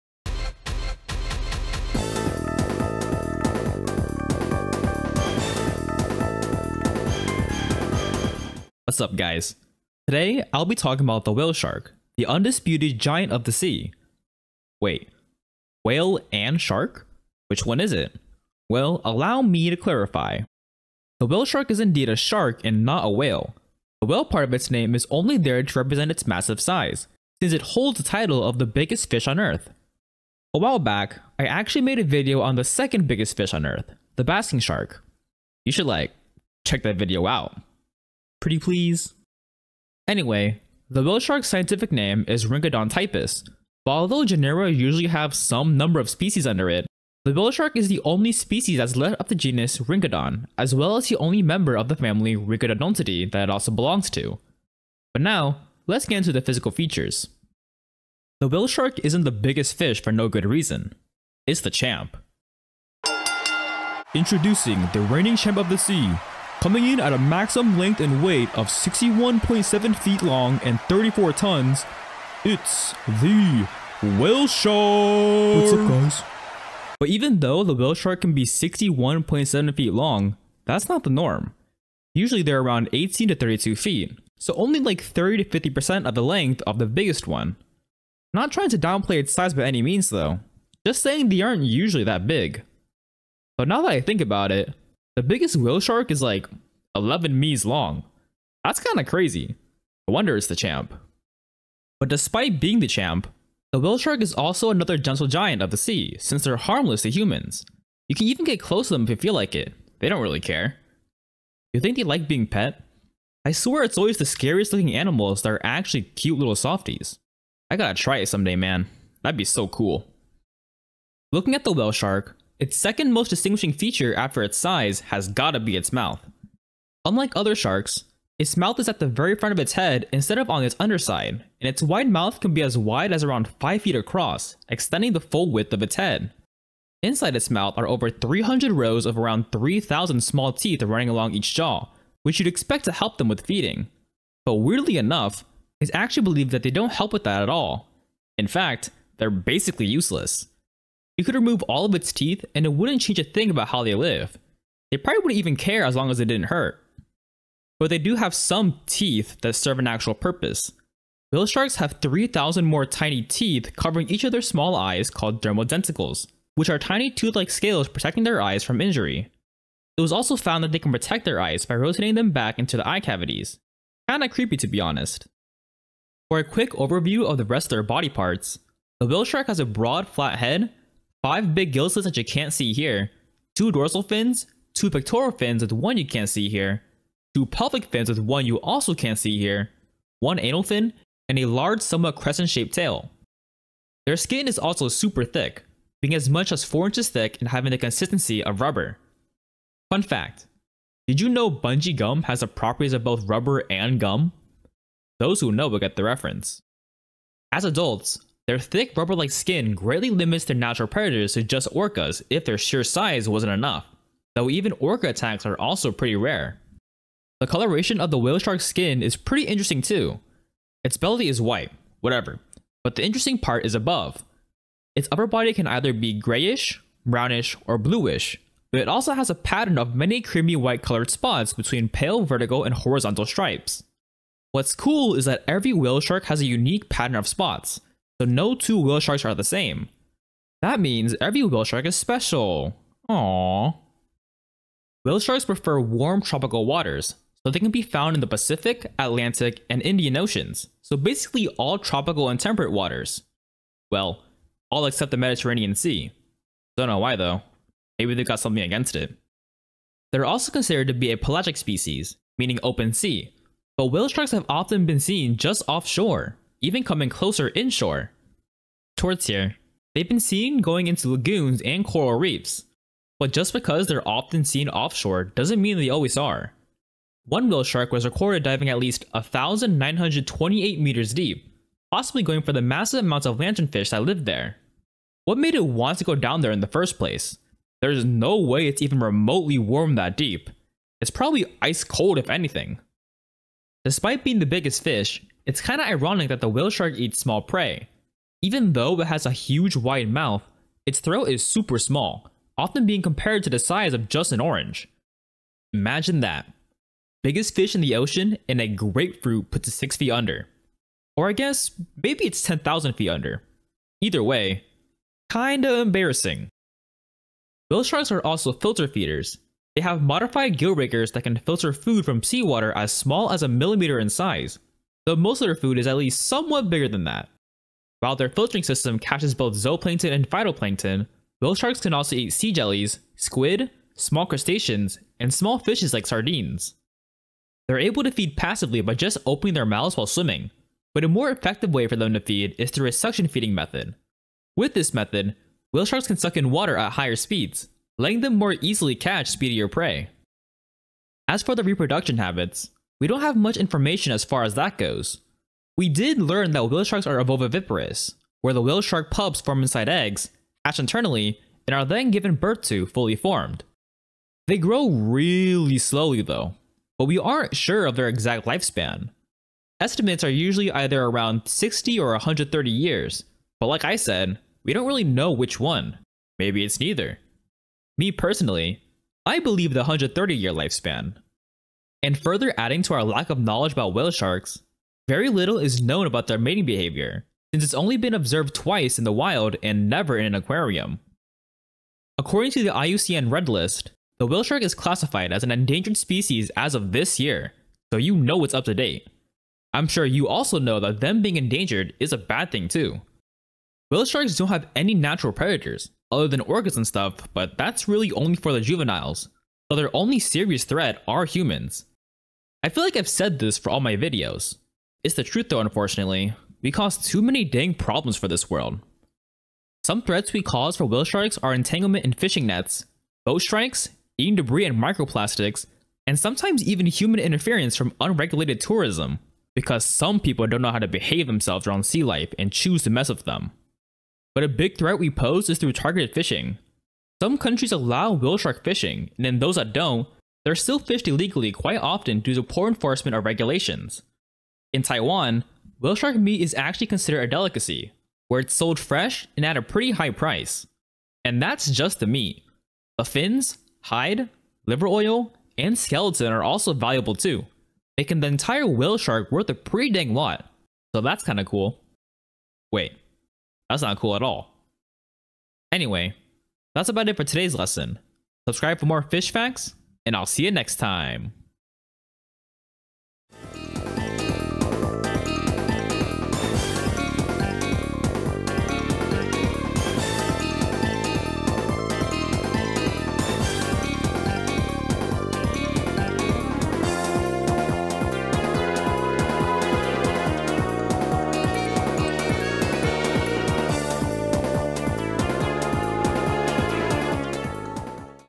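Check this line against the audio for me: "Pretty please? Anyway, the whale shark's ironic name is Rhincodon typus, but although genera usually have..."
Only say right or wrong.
wrong.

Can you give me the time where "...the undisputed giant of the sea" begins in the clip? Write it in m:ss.
0:12.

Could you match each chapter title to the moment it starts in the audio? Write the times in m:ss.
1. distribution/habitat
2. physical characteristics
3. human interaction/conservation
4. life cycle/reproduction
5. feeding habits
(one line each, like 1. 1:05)
1. 4:05
2. 0:58
3. 6:32
4. 5:51
5. 4:53.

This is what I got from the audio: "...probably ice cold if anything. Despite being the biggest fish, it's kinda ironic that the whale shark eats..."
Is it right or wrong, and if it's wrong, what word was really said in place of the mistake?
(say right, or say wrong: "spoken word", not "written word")
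right.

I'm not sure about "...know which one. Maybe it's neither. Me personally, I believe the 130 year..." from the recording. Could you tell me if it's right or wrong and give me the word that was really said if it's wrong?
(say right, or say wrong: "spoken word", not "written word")
right.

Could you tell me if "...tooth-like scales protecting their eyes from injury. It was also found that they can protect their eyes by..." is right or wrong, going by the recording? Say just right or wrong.
right.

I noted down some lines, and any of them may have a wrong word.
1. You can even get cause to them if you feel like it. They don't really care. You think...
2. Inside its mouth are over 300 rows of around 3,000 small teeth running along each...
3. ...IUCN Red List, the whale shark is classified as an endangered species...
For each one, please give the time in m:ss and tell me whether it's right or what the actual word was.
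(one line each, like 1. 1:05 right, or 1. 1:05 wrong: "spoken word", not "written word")
1. 1:48 wrong: "close", not "cause"
2. 2:17 right
3. 6:32 right.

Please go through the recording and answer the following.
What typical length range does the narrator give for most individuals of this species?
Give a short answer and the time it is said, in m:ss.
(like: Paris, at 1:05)
18 to 32 feet, at 1:22.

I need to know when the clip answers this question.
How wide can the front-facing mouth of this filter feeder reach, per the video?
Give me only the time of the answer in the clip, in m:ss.
2:13.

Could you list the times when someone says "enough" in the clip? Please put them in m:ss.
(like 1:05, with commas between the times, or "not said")
2:24, 3:33.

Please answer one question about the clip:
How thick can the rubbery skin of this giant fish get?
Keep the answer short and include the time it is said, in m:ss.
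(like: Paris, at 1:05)
4 inches, at 3:16.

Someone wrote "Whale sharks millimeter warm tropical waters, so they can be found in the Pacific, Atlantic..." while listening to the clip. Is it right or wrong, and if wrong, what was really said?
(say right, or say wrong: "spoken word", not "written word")
wrong: "prefer", not "millimeter".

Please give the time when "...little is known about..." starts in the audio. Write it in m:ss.
6:25.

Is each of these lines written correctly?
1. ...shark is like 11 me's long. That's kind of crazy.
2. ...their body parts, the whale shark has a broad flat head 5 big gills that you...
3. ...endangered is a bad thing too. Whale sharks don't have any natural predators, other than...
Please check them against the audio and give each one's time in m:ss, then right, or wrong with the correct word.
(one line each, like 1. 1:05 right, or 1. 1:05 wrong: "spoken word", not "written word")
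1. 1:35 right
2. 2:57 right
3. 6:41 right.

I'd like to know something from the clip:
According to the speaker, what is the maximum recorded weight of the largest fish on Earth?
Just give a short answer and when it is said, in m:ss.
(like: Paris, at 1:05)
34 tons, at 1:10.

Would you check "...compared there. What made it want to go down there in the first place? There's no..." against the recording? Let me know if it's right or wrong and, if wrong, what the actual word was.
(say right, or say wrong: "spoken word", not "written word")
wrong: "lived", not "compared".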